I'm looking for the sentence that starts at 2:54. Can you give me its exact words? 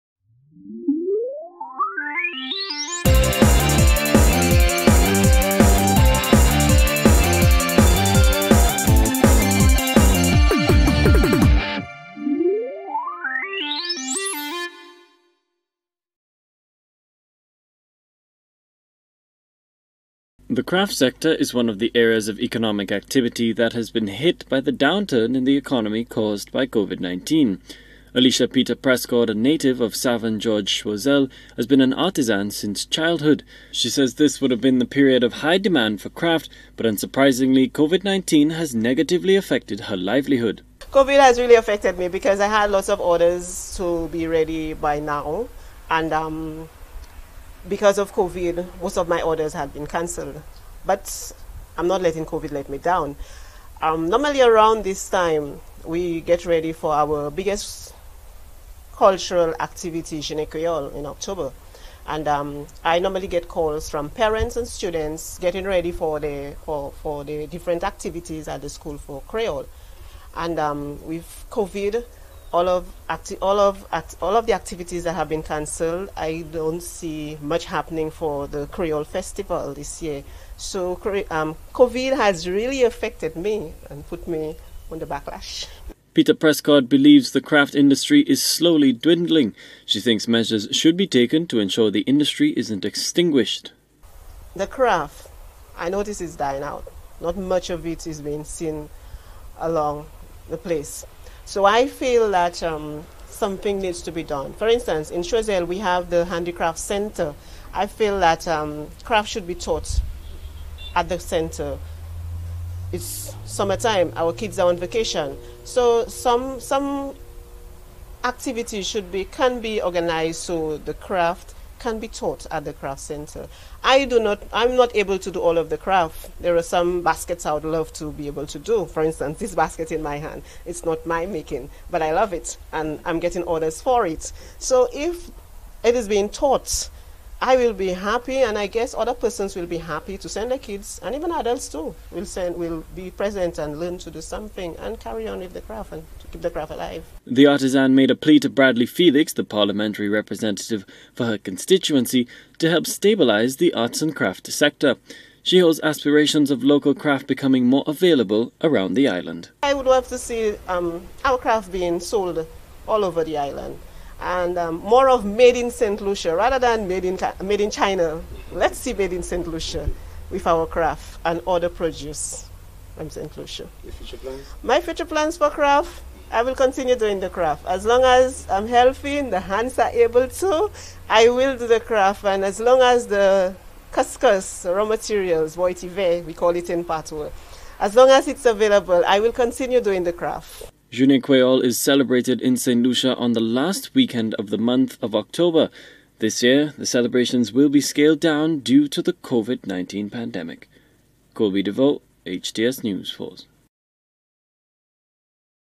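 My future plans for craft, I will continue doing the craft.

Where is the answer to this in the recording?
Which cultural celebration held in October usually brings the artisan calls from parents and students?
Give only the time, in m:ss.
1:00.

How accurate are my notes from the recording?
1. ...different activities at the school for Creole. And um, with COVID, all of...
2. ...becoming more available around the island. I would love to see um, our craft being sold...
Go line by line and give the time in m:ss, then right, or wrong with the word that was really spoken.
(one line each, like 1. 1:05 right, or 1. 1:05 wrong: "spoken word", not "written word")
1. 1:07 right
2. 2:37 right.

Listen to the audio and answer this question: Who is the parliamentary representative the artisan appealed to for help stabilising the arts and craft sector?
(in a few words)
Bradley Felix.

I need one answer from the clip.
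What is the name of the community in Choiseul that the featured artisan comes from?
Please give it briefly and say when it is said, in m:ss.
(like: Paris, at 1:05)
Savon George, at 0:29.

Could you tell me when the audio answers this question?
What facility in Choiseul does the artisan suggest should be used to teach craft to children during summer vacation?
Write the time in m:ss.
1:46.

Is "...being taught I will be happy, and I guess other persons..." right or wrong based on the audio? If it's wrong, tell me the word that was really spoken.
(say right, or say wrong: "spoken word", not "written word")
right.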